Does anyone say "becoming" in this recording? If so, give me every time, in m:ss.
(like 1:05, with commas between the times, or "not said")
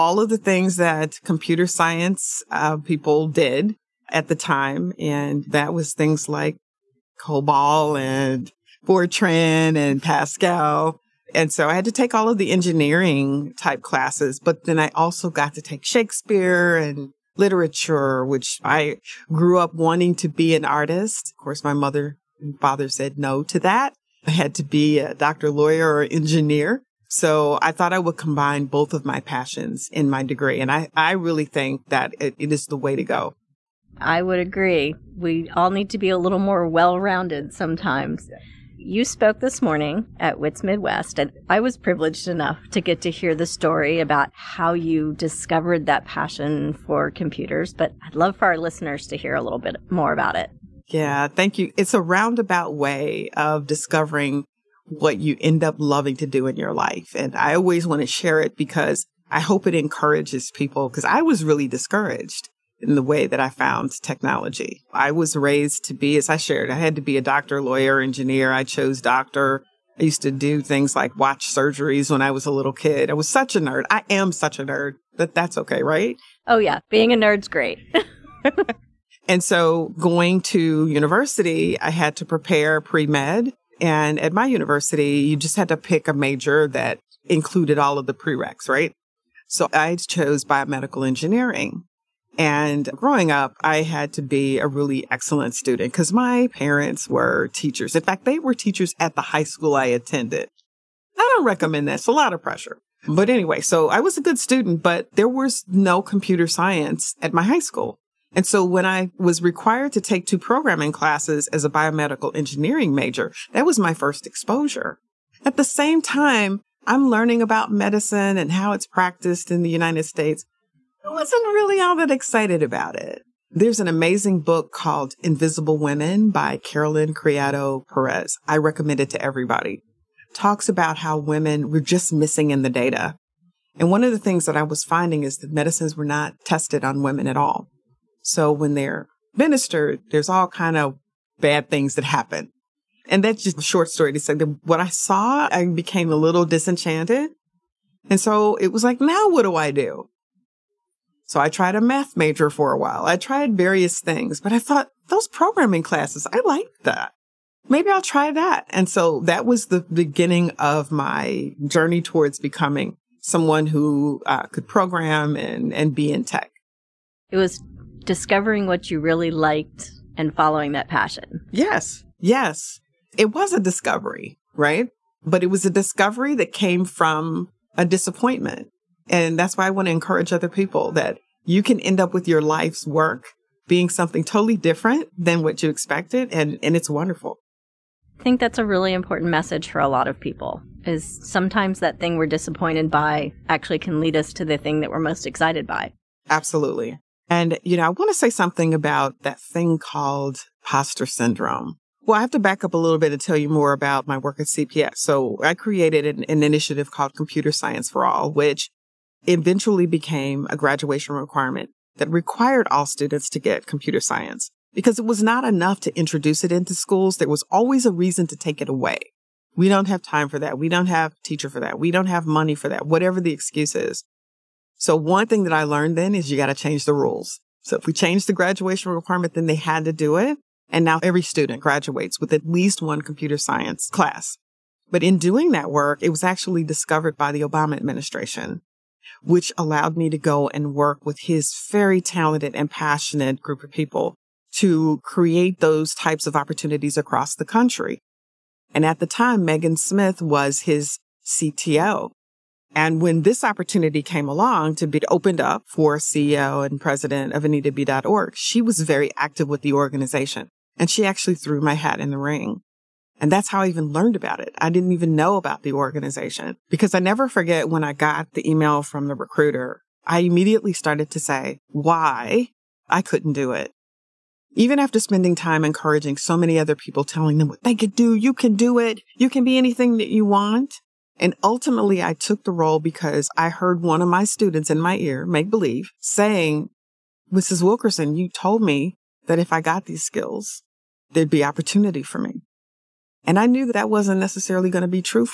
2:42.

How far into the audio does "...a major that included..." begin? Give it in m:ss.
1:26.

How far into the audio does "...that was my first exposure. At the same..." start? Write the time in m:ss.
1:53.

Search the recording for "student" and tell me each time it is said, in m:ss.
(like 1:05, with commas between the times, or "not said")
1:35, 1:44, 3:32, 3:51, 4:44.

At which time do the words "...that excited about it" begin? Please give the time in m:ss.
2:01.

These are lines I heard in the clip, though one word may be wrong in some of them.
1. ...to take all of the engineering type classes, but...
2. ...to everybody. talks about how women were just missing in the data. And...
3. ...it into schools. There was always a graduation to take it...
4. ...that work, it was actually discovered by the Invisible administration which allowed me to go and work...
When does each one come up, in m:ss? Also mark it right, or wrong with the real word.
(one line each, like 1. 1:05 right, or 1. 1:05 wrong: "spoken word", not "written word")
1. 0:11 right
2. 2:09 right
3. 3:36 wrong: "reason", not "graduation"
4. 3:55 wrong: "Obama", not "Invisible".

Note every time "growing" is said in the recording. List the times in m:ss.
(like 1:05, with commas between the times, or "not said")
1:32.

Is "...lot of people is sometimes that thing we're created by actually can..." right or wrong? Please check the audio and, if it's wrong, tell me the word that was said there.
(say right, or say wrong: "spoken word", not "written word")
wrong: "disappointed", not "created".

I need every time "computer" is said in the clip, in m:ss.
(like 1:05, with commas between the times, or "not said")
0:01, 0:47, 1:46, 3:27, 3:33, 3:53.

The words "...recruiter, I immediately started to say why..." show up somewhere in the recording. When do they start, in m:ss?
4:29.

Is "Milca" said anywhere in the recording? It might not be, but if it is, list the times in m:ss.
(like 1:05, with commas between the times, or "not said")
not said.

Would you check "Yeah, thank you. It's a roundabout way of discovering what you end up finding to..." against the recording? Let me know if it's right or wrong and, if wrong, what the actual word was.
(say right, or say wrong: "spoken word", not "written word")
wrong: "loving", not "finding".